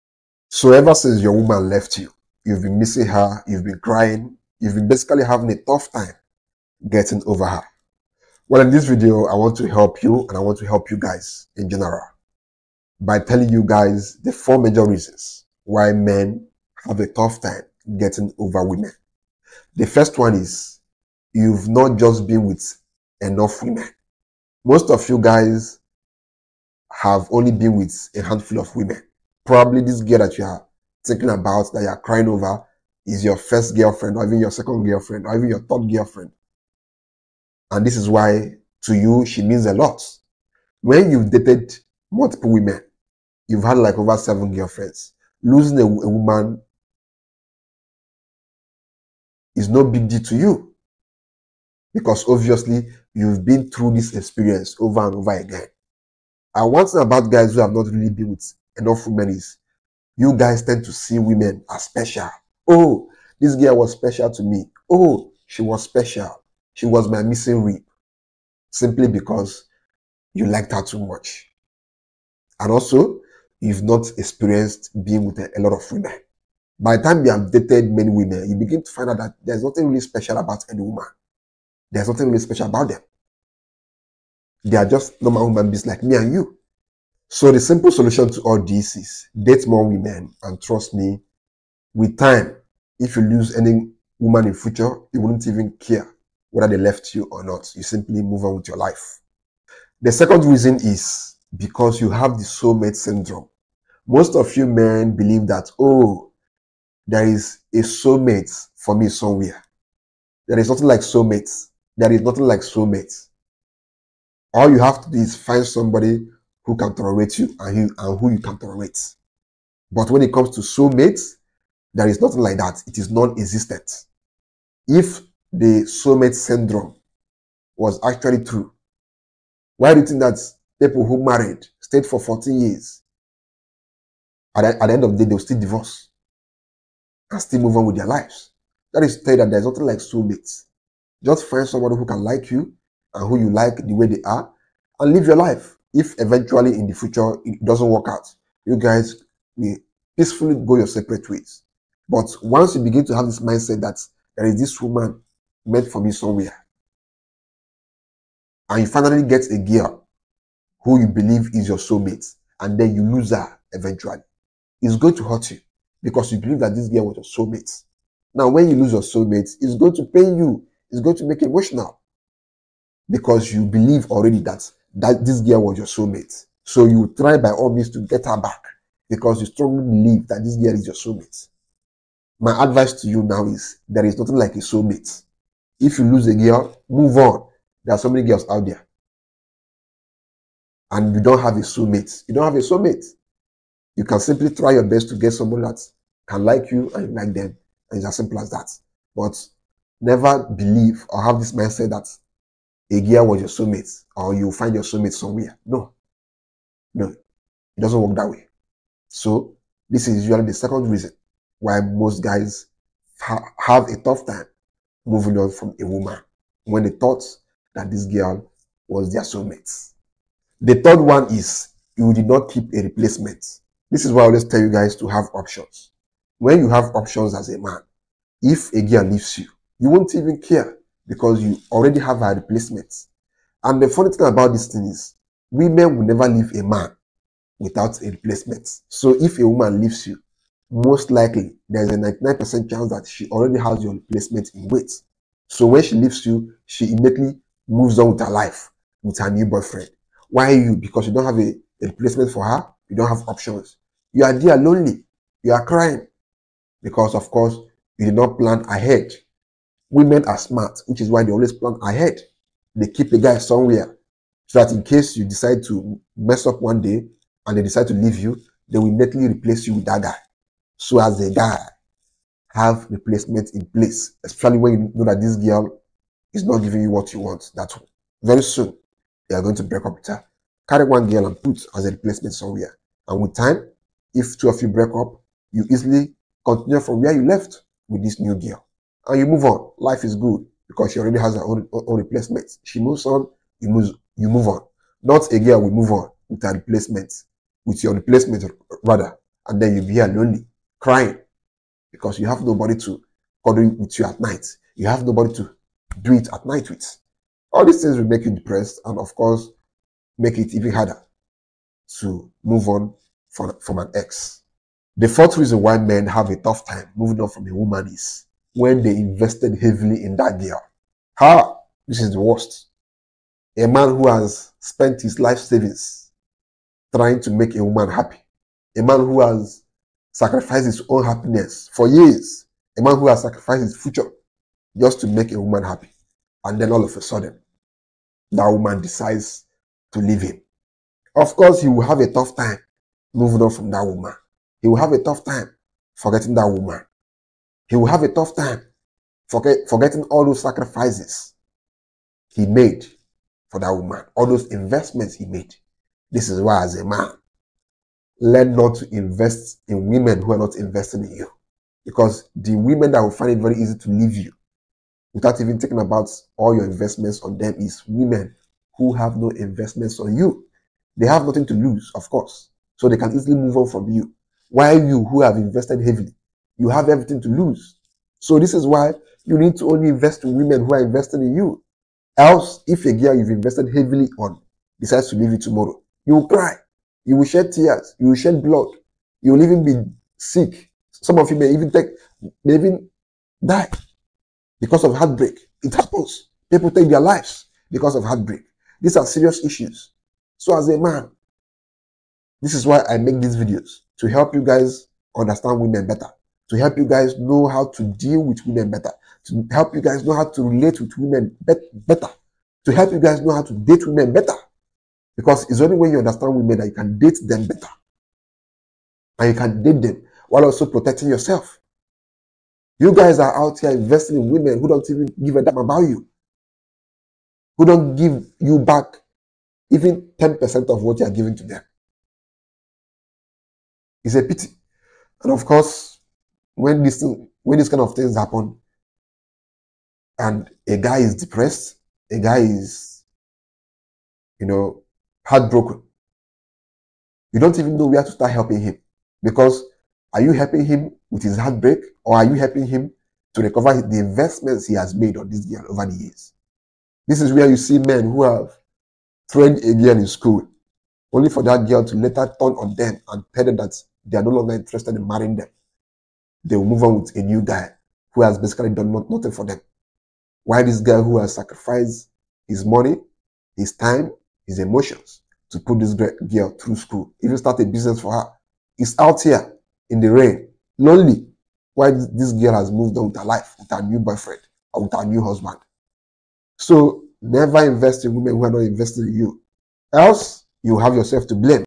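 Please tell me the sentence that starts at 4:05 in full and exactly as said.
So when she leaves you, she immediately moves on with her life, with her new boyfriend.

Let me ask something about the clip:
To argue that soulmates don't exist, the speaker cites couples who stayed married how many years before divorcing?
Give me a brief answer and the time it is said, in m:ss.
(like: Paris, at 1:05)
14, at 2:12.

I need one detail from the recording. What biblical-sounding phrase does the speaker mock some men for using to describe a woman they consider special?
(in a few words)
missing rib.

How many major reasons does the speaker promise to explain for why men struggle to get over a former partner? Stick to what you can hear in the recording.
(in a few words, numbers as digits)
4.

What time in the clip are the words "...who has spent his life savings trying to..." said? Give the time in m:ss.
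5:23.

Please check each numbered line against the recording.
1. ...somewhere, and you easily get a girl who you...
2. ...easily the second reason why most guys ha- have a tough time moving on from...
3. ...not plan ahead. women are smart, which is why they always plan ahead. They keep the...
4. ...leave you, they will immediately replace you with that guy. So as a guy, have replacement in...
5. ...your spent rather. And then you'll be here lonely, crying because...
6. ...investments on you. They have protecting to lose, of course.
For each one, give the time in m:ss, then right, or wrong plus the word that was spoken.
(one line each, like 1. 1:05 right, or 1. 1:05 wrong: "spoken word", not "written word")
1. 2:36 wrong: "finally", not "easily"
2. 3:30 wrong: "usually", not "easily"
3. 4:18 right
4. 4:27 right
5. 4:57 wrong: "replacement", not "spent"
6. 6:09 wrong: "nothing", not "protecting".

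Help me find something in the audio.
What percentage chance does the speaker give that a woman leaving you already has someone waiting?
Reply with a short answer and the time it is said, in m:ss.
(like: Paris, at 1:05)
99%, at 4:01.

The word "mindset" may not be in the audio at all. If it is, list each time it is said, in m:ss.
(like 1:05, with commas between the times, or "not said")
2:33, 3:21.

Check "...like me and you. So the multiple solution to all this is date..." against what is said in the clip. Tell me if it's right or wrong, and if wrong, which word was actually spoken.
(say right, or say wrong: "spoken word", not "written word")
wrong: "simple", not "multiple".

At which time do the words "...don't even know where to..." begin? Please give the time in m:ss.
7:27.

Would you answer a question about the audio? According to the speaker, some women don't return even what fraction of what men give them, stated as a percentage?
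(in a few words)
10%.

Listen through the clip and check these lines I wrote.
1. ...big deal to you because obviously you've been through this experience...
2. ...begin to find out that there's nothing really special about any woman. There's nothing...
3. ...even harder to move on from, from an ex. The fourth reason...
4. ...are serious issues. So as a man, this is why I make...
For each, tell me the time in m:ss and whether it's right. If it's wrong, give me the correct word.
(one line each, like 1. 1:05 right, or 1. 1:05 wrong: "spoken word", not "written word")
1. 0:49 right
2. 1:18 right
3. 5:10 right
4. 6:38 right.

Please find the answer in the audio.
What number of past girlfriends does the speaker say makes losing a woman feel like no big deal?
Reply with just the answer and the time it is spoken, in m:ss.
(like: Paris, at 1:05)
7, at 0:44.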